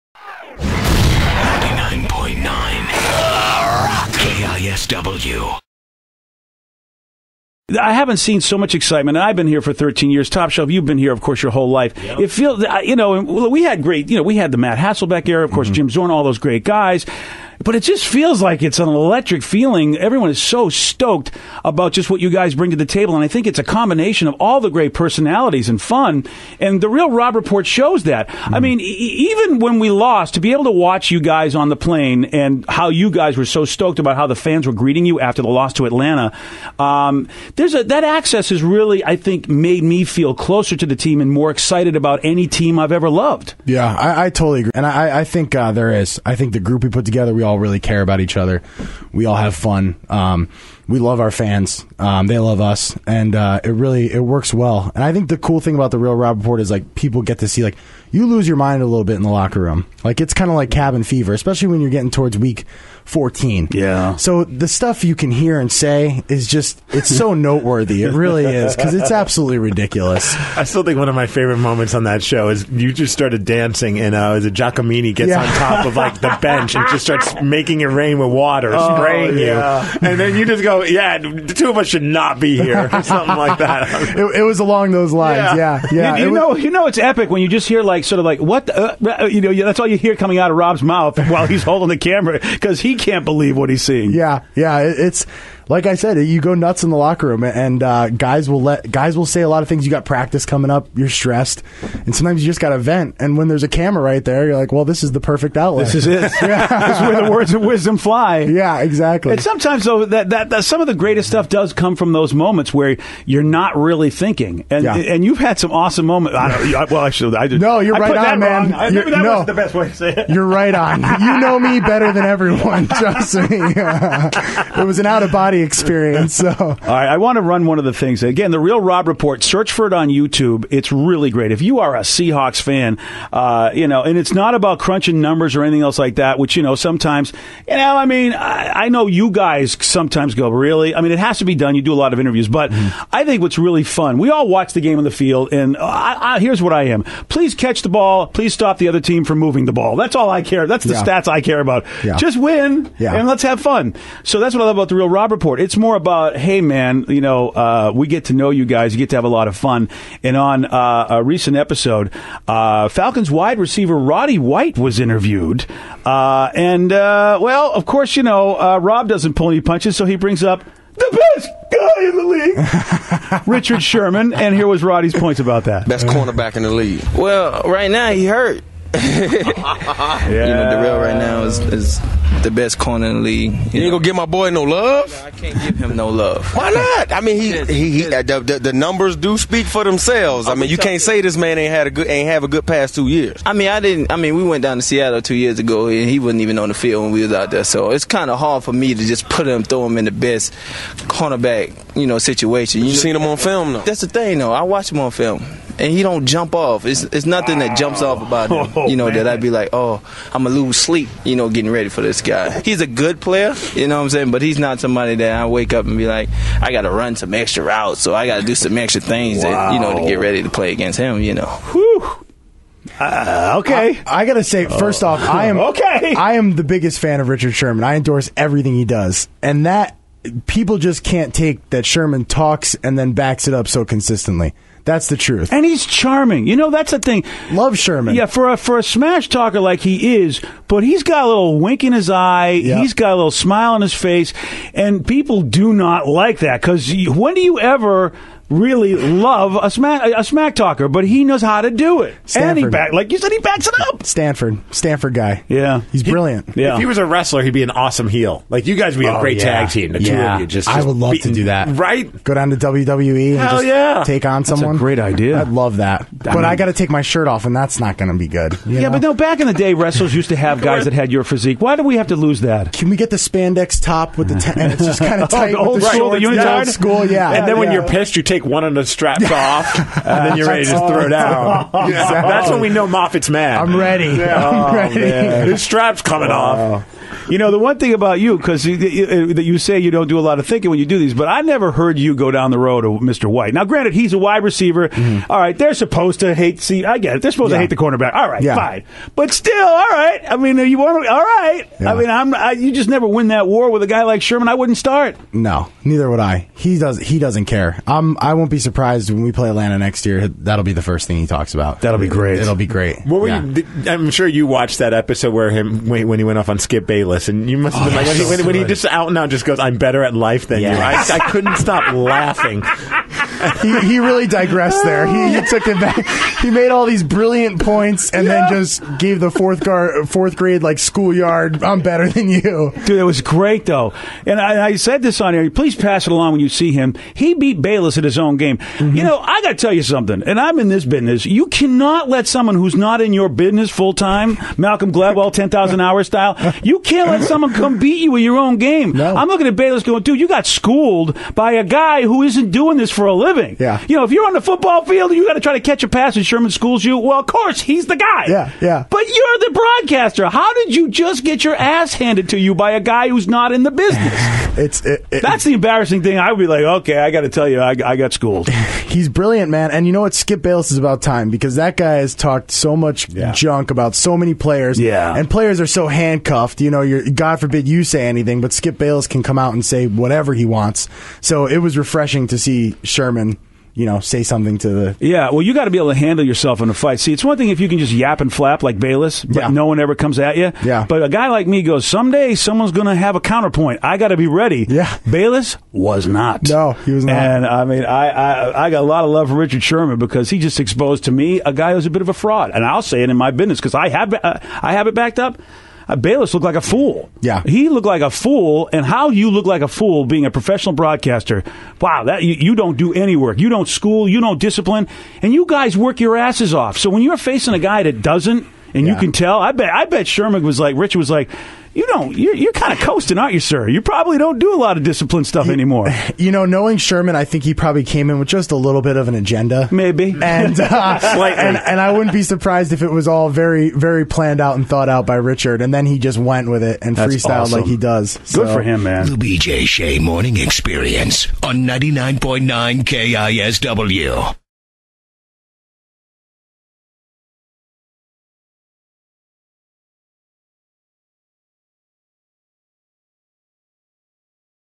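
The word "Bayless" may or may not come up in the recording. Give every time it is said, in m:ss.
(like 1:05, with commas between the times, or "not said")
5:16, 5:37, 5:49, 6:10, 6:18, 6:28, 6:35, 6:45.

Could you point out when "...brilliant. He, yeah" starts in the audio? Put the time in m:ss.
4:16.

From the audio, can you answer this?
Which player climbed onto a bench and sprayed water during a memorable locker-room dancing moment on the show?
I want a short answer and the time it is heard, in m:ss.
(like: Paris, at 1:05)
Giacomini, at 1:14.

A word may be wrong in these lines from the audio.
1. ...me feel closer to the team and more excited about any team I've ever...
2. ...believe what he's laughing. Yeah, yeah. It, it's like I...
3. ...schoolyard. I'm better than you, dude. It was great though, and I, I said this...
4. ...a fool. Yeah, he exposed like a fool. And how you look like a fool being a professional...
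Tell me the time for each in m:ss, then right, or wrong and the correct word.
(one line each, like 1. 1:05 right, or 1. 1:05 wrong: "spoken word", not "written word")
1. 0:39 right
2. 1:33 wrong: "seeing", not "laughing"
3. 5:30 right
4. 6:46 wrong: "looked", not "exposed".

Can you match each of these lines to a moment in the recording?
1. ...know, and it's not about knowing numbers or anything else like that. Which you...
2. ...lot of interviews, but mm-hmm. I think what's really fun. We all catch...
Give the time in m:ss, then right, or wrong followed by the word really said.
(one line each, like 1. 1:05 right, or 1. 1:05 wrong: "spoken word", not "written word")
1. 2:13 wrong: "crunching", not "knowing"
2. 2:21 wrong: "watch", not "catch".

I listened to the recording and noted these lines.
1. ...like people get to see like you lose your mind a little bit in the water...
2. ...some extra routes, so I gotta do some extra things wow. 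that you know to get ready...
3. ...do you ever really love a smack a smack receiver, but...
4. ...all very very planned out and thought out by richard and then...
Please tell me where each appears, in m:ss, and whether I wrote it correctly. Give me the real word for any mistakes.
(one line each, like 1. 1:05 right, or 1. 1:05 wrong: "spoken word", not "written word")
1. 0:56 wrong: "locker", not "water"
2. 3:37 right
3. 4:07 wrong: "talker", not "receiver"
4. 7:13 right.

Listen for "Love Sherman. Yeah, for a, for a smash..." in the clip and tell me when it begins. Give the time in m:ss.
3:57.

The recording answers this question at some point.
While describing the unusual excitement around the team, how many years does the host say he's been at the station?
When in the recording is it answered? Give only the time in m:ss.
0:09.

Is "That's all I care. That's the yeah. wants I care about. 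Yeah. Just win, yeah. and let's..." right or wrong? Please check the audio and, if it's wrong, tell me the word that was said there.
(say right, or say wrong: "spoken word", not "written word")
wrong: "stats", not "wants".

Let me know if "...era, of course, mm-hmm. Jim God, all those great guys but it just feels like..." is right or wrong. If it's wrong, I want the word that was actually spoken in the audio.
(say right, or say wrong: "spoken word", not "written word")
wrong: "Zorn", not "God".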